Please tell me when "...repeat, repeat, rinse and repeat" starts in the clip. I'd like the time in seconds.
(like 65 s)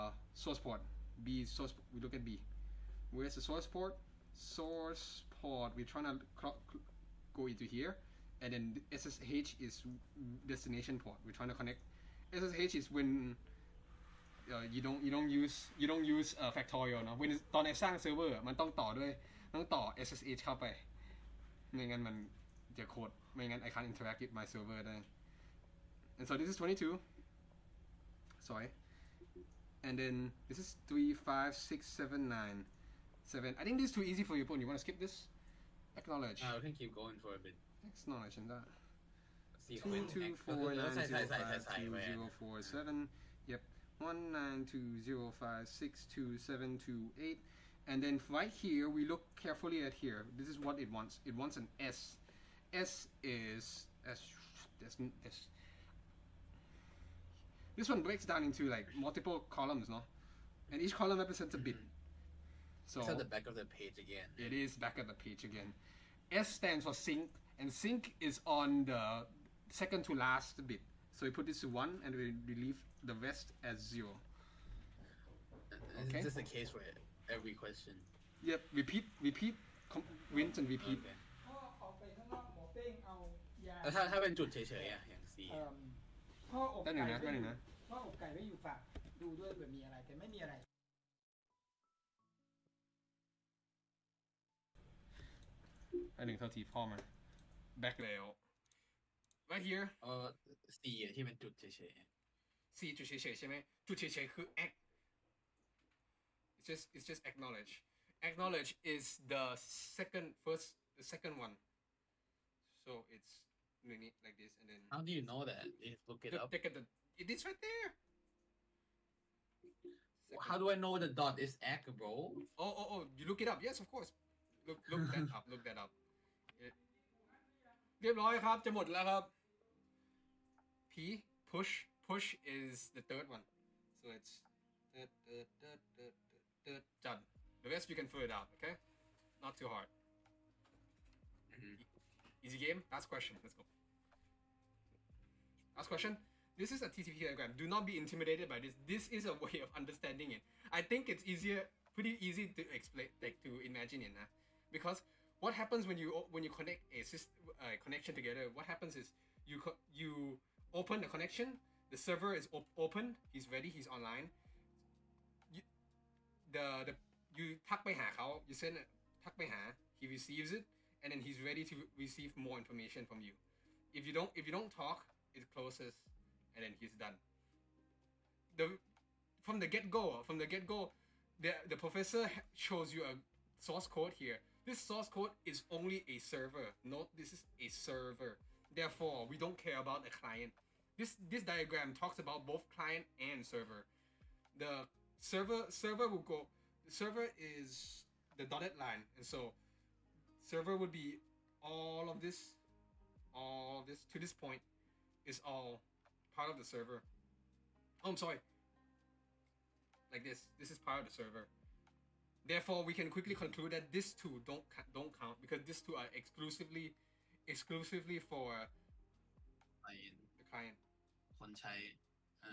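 78 s.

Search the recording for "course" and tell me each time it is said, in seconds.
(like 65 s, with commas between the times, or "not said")
123 s.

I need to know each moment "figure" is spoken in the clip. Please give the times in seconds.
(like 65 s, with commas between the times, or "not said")
138 s.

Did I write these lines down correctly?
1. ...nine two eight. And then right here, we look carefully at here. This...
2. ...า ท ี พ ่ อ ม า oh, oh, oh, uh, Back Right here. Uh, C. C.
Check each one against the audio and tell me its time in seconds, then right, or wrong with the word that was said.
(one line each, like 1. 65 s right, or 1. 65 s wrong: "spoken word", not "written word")
1. 46 s wrong: "seven", not "nine"
2. 96 s right.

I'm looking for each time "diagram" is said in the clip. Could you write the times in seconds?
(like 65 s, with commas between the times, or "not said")
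147 s, 191 s.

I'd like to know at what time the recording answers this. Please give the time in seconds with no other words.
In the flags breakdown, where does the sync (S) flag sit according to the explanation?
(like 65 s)
69 s.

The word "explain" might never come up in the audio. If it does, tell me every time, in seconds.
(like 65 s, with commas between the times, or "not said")
152 s.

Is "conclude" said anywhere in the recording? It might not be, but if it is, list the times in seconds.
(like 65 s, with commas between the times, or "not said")
213 s.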